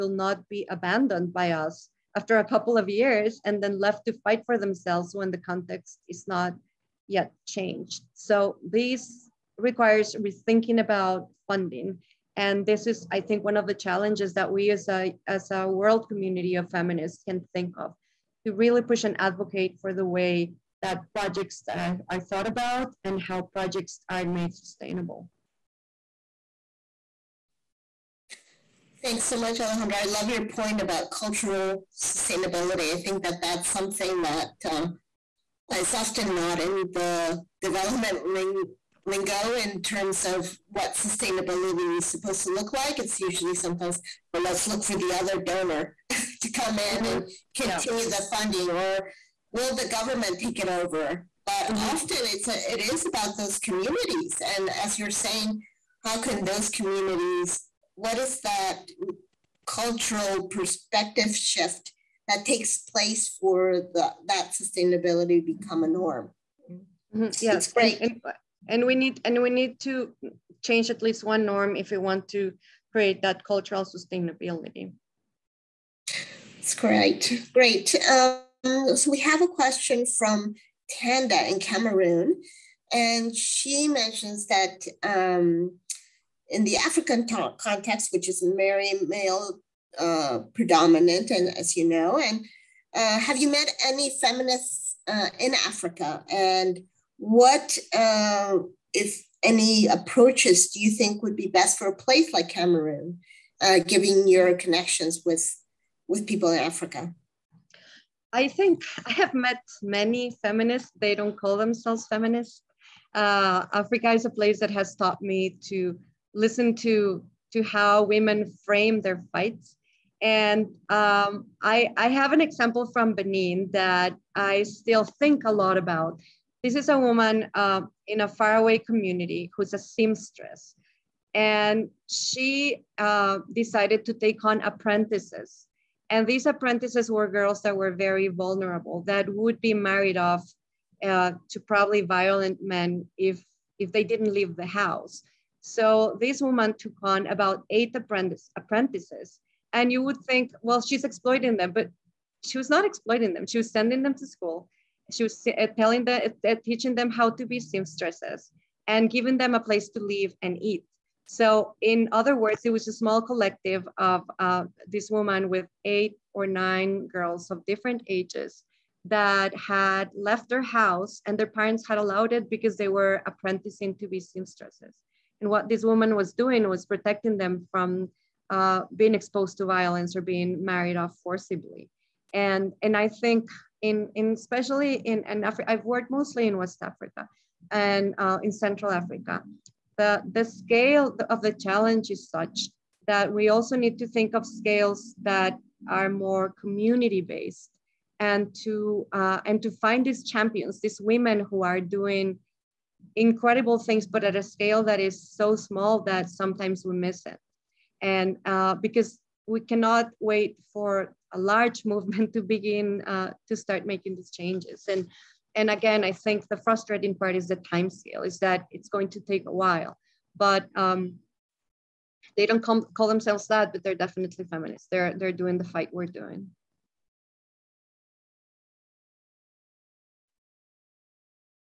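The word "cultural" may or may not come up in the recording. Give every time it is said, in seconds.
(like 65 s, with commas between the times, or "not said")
31 s, 59 s, 73 s.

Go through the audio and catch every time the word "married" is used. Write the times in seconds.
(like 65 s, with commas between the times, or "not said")
139 s, 180 s.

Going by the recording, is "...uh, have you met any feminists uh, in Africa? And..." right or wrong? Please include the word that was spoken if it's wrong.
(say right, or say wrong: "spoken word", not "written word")
right.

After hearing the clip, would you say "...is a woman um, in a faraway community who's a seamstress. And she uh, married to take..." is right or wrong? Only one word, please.
wrong.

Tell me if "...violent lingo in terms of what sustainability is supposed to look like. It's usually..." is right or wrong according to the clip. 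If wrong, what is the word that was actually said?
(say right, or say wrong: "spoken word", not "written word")
wrong: "development", not "violent".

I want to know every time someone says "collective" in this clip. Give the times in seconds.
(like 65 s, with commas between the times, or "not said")
163 s.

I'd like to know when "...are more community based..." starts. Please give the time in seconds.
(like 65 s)
195 s.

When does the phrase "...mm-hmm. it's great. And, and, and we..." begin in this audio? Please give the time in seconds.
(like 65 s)
67 s.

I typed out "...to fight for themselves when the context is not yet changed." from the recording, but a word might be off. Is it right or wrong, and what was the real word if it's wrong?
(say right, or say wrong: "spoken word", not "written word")
right.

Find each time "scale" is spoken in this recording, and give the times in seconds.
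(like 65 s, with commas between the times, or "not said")
190 s, 194 s, 204 s, 217 s.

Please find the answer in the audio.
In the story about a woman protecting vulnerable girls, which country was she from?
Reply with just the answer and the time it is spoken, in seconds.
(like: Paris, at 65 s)
Benin, at 123 s.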